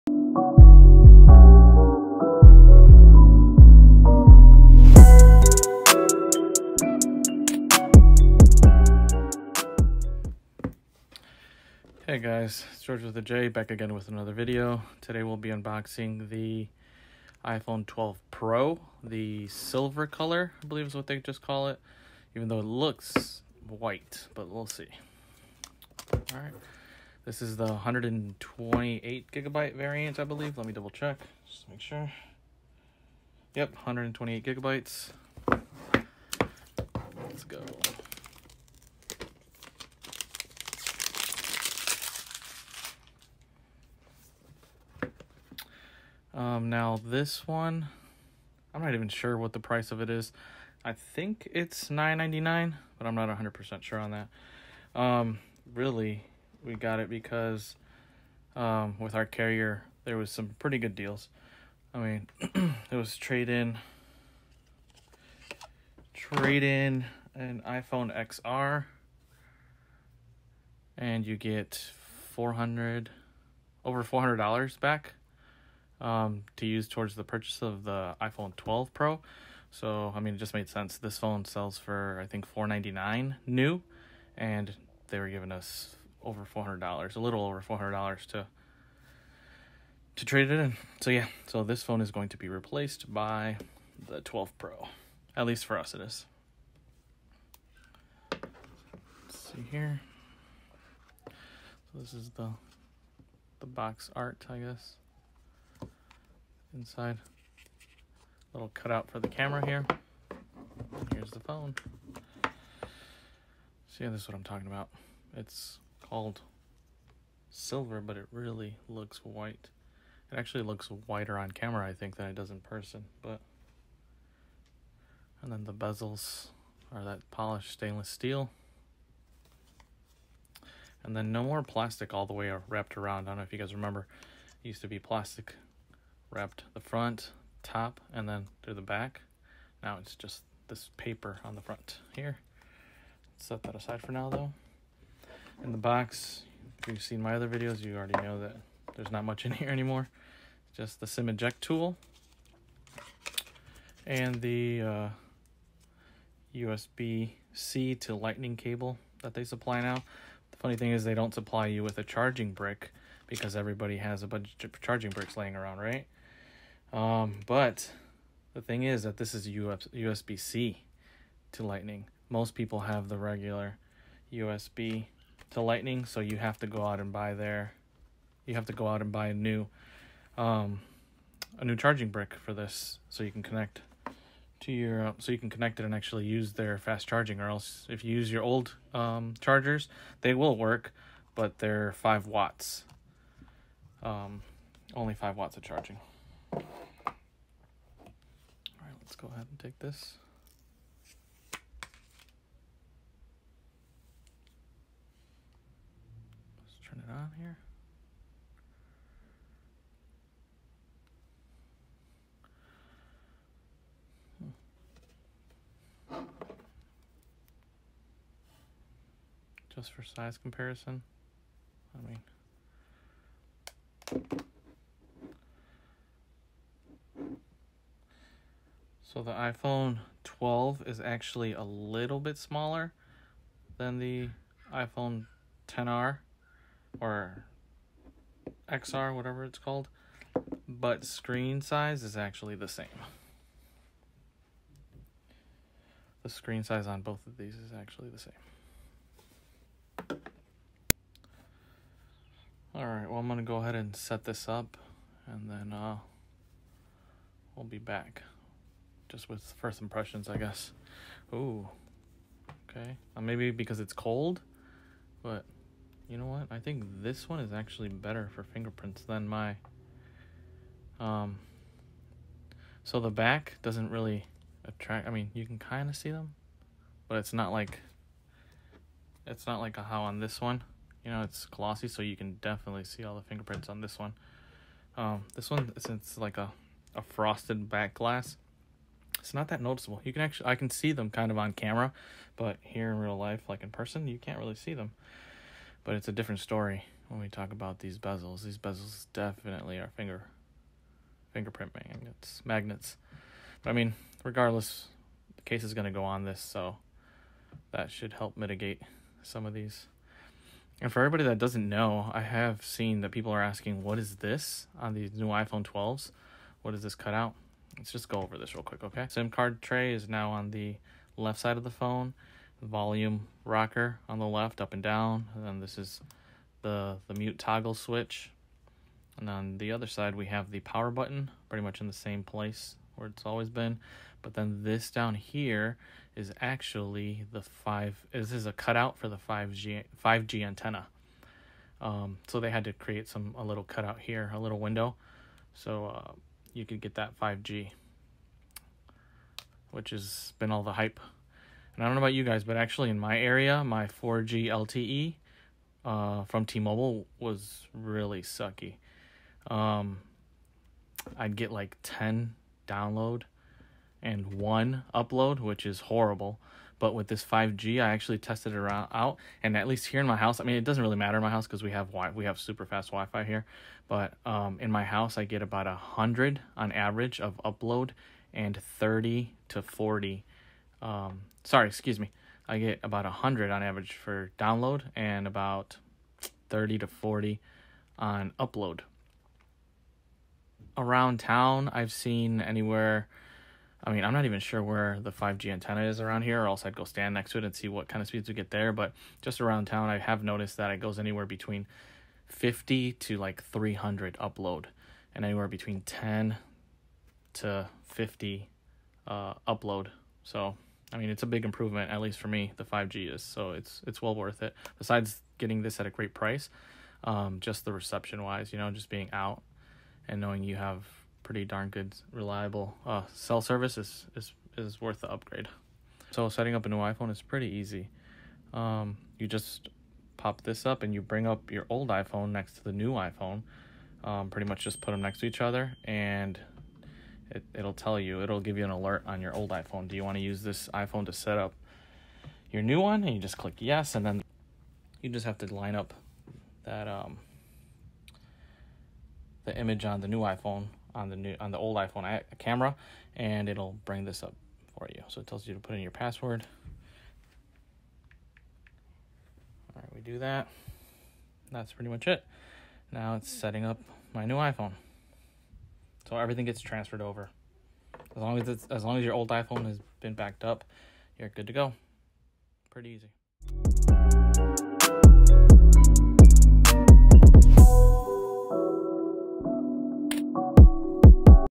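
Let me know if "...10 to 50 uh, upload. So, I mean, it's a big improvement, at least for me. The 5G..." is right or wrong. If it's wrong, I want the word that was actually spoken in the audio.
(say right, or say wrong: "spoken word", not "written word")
right.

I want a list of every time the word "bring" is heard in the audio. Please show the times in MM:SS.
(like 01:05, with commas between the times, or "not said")
07:11, 07:33.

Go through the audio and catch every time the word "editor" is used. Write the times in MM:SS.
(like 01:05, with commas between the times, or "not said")
not said.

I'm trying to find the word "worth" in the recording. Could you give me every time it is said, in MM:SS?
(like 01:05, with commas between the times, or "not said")
06:54, 07:04.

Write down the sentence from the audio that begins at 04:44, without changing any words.
Um, this one since like a, a frosted back glass, it's not that noticeable.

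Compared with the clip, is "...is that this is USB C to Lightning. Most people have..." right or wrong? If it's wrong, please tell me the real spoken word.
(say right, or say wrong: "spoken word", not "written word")
right.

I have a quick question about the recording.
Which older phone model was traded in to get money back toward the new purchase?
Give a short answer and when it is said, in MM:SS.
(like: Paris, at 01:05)
iPhone XR, at 01:07.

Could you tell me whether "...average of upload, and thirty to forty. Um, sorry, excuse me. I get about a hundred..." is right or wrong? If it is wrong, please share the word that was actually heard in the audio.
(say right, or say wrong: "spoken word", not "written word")
right.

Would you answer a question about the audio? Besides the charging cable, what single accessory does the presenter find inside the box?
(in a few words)
sim eject tool.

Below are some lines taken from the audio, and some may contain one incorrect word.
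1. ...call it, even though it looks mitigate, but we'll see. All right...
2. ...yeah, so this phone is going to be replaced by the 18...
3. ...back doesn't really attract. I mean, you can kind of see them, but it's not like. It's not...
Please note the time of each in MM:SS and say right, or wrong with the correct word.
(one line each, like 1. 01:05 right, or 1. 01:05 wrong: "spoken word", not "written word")
1. 00:21 wrong: "white", not "mitigate"
2. 01:31 wrong: "12", not "18"
3. 04:33 right.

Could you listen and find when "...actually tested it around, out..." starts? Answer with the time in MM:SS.
06:07.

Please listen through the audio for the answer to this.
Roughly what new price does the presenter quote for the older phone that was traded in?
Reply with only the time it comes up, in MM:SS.
01:22.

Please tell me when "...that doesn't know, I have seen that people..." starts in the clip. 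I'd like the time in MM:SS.
05:11.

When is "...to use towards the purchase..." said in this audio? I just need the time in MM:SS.
01:16.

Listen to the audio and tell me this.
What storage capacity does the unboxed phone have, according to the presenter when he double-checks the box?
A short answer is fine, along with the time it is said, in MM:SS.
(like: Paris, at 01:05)
128 gigabytes, at 00:33.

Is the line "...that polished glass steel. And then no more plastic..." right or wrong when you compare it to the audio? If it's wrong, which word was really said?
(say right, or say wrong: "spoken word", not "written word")
wrong: "stainless", not "glass".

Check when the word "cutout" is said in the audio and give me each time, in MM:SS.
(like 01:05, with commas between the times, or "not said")
01:48, 05:16, 05:38, 05:43.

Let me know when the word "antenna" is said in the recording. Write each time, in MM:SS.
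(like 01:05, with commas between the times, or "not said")
05:40, 06:35.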